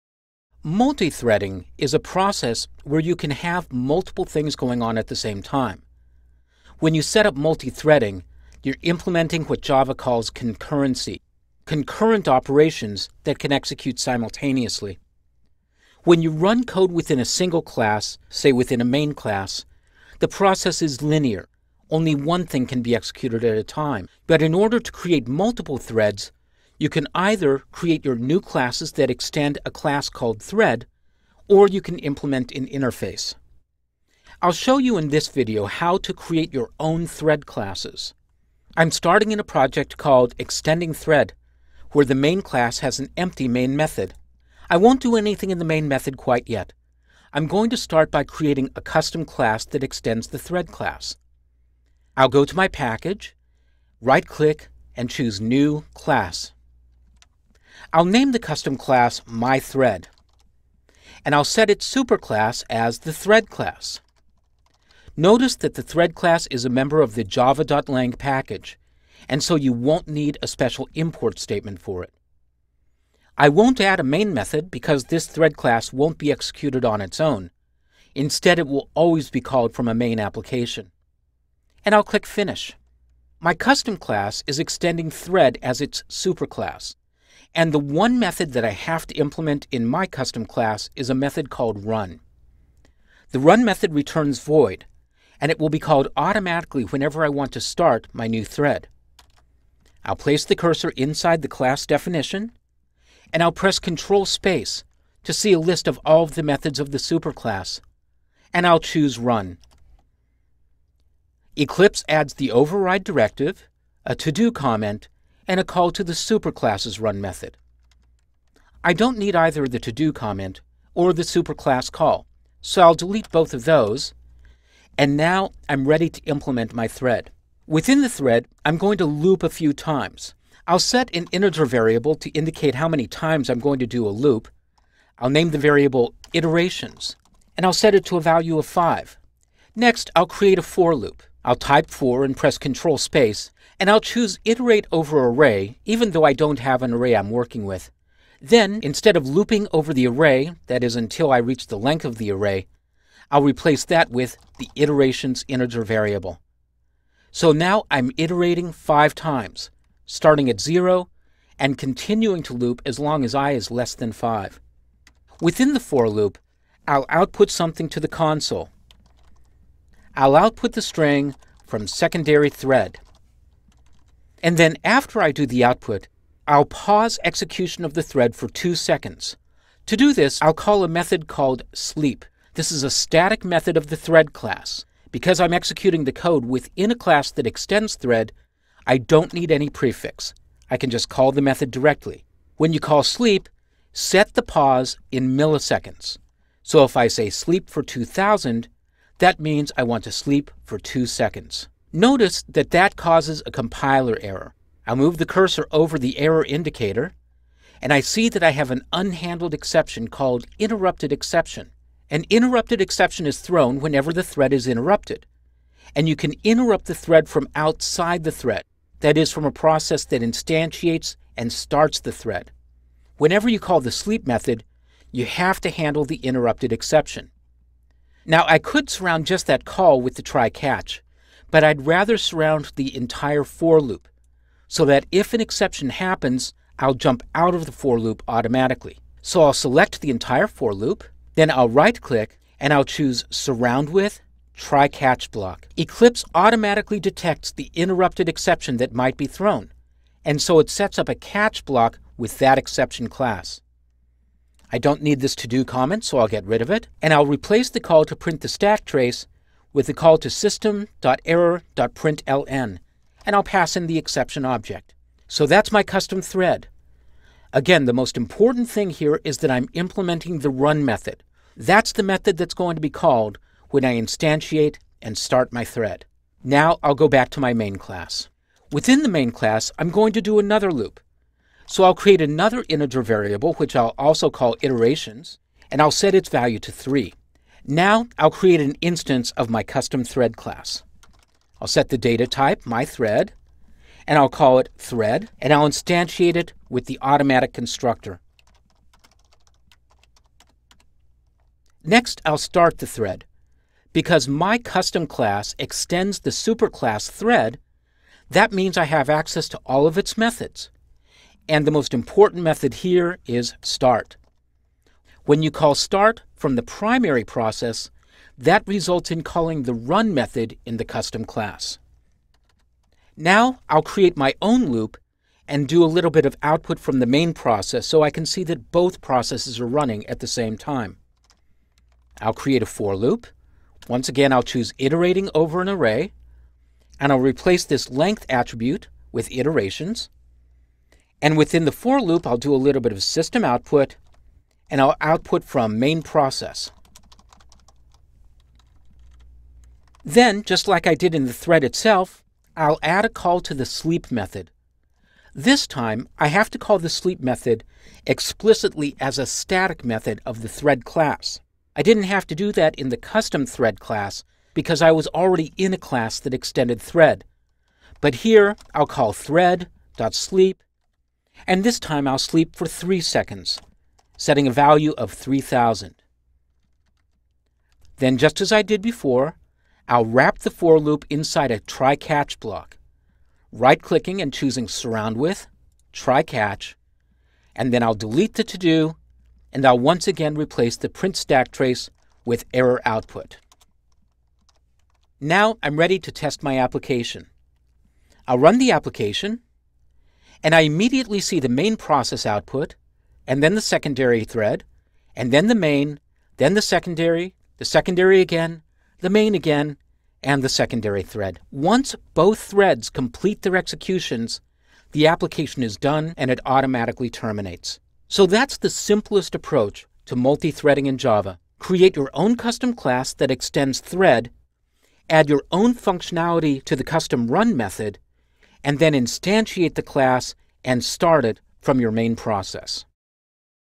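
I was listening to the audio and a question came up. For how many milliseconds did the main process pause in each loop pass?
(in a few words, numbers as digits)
3000.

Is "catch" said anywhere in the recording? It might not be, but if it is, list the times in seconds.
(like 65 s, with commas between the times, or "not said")
230 s, 244 s, 251 s, 381 s, 386 s.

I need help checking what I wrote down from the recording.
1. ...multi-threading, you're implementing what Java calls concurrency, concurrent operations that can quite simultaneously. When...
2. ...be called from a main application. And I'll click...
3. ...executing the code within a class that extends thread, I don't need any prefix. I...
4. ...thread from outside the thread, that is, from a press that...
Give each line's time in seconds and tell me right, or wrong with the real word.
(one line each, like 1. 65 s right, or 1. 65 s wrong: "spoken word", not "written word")
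1. 7 s wrong: "execute", not "quite"
2. 79 s right
3. 185 s right
4. 216 s wrong: "process", not "press".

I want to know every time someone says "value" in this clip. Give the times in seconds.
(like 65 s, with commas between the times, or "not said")
138 s, 286 s, 374 s.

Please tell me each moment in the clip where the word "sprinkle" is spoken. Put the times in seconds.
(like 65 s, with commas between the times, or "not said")
not said.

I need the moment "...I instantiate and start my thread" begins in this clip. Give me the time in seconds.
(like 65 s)
273 s.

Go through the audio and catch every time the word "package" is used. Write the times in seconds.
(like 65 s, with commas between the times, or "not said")
52 s, 68 s.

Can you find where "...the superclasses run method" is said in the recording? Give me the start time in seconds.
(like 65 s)
116 s.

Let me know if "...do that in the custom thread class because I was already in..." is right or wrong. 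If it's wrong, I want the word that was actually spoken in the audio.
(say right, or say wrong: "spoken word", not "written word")
right.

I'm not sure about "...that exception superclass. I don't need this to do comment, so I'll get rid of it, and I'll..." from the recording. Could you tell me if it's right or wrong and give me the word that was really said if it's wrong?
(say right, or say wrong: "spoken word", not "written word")
wrong: "class", not "superclass".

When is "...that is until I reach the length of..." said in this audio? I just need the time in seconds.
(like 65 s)
150 s.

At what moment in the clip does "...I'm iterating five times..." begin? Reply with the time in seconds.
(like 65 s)
157 s.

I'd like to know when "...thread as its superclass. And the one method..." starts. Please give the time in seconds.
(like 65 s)
85 s.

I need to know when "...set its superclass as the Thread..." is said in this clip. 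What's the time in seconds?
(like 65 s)
61 s.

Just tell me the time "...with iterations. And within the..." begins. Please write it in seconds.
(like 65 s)
339 s.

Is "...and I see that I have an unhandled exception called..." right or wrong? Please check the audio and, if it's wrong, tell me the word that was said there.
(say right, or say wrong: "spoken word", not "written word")
right.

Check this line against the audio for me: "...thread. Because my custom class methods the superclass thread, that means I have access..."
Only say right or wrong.
wrong.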